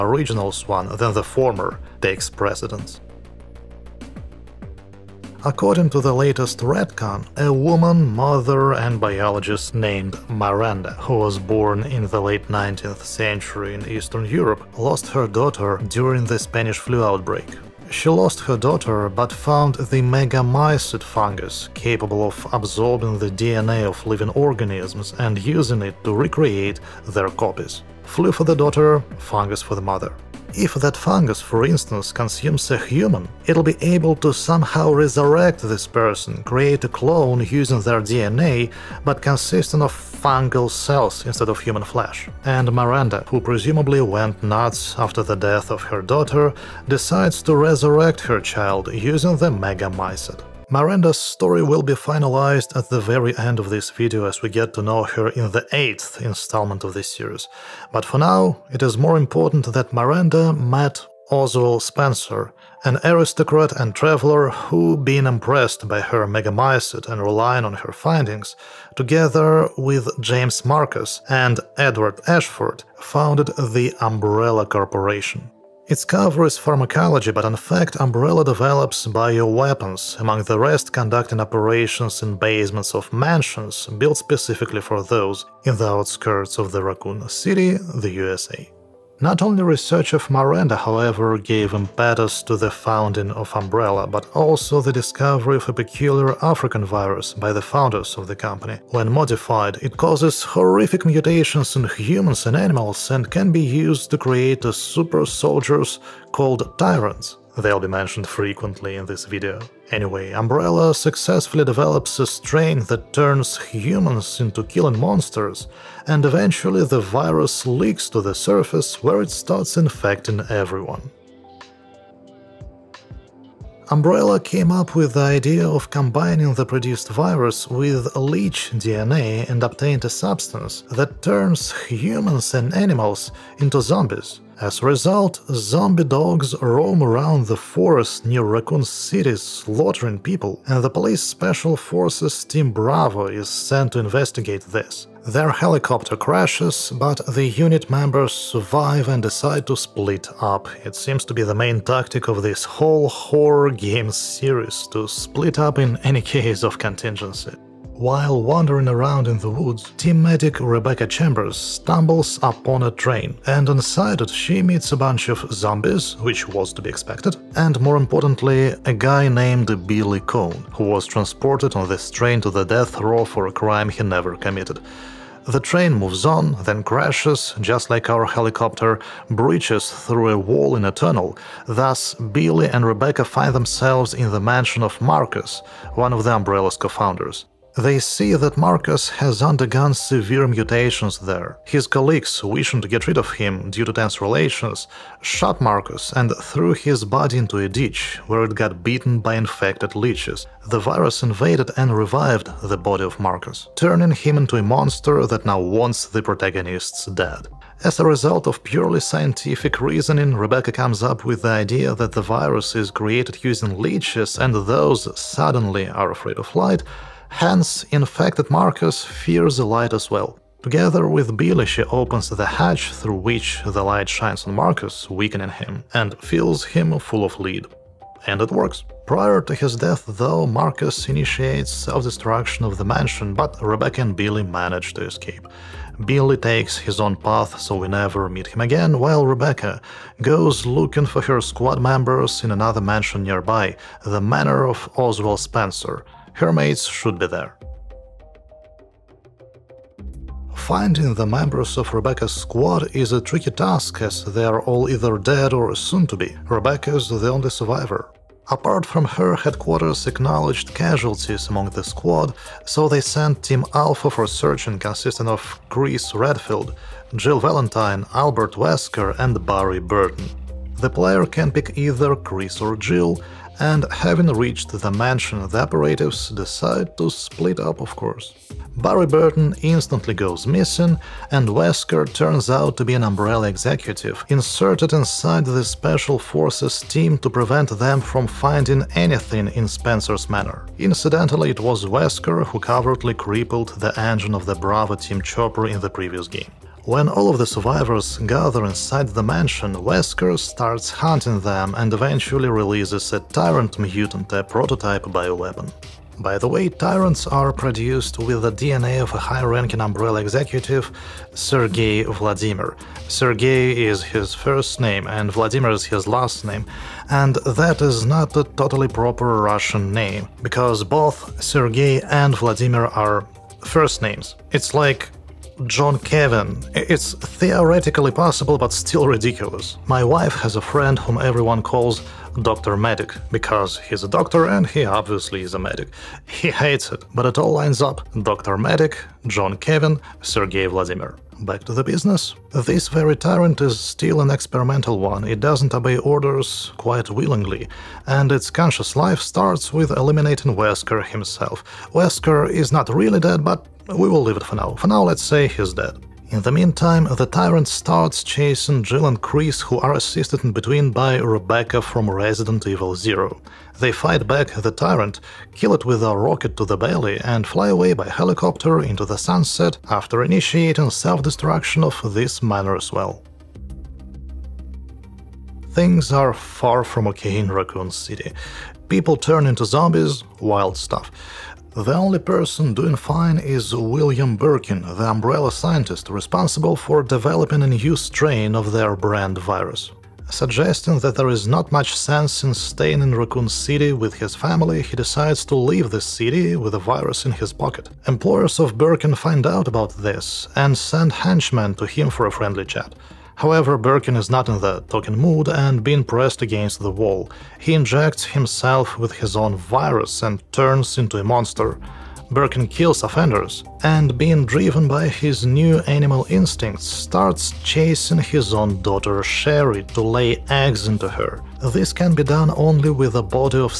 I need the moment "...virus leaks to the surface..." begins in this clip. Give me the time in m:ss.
1:57.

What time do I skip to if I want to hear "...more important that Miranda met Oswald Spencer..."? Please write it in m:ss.
0:58.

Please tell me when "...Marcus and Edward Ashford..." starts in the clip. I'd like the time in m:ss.
1:10.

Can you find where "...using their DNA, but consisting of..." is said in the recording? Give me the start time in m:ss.
0:37.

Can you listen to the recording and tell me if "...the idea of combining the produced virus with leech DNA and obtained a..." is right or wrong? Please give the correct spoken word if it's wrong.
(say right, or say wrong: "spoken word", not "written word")
right.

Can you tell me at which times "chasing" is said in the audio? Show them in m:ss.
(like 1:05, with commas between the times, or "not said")
5:58, 6:57.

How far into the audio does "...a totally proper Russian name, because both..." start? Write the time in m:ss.
5:18.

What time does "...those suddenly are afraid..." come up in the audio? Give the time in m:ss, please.
3:34.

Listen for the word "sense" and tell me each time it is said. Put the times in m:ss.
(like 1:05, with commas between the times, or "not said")
6:31.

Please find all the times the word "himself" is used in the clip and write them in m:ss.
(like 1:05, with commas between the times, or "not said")
5:51, 6:48.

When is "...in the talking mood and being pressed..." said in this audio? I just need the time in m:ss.
6:44.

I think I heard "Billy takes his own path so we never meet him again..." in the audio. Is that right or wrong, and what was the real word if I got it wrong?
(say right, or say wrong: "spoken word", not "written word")
right.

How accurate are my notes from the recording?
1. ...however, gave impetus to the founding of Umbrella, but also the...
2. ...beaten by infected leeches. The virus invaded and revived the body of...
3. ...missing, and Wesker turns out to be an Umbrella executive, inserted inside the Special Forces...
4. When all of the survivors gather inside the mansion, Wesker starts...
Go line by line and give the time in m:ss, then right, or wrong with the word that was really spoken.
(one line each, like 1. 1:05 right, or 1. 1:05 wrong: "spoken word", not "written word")
1. 1:30 right
2. 3:18 right
3. 4:40 right
4. 4:56 right.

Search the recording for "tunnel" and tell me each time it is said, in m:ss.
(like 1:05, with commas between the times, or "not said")
3:00.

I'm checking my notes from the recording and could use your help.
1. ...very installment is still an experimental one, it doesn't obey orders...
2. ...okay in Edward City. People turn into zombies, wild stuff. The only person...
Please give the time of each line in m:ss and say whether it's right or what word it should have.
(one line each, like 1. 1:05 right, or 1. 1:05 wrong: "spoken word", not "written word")
1. 5:42 wrong: "tyrant", not "installment"
2. 6:17 wrong: "Raccoon", not "Edward".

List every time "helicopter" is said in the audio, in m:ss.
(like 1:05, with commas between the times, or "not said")
2:25, 2:58, 6:08.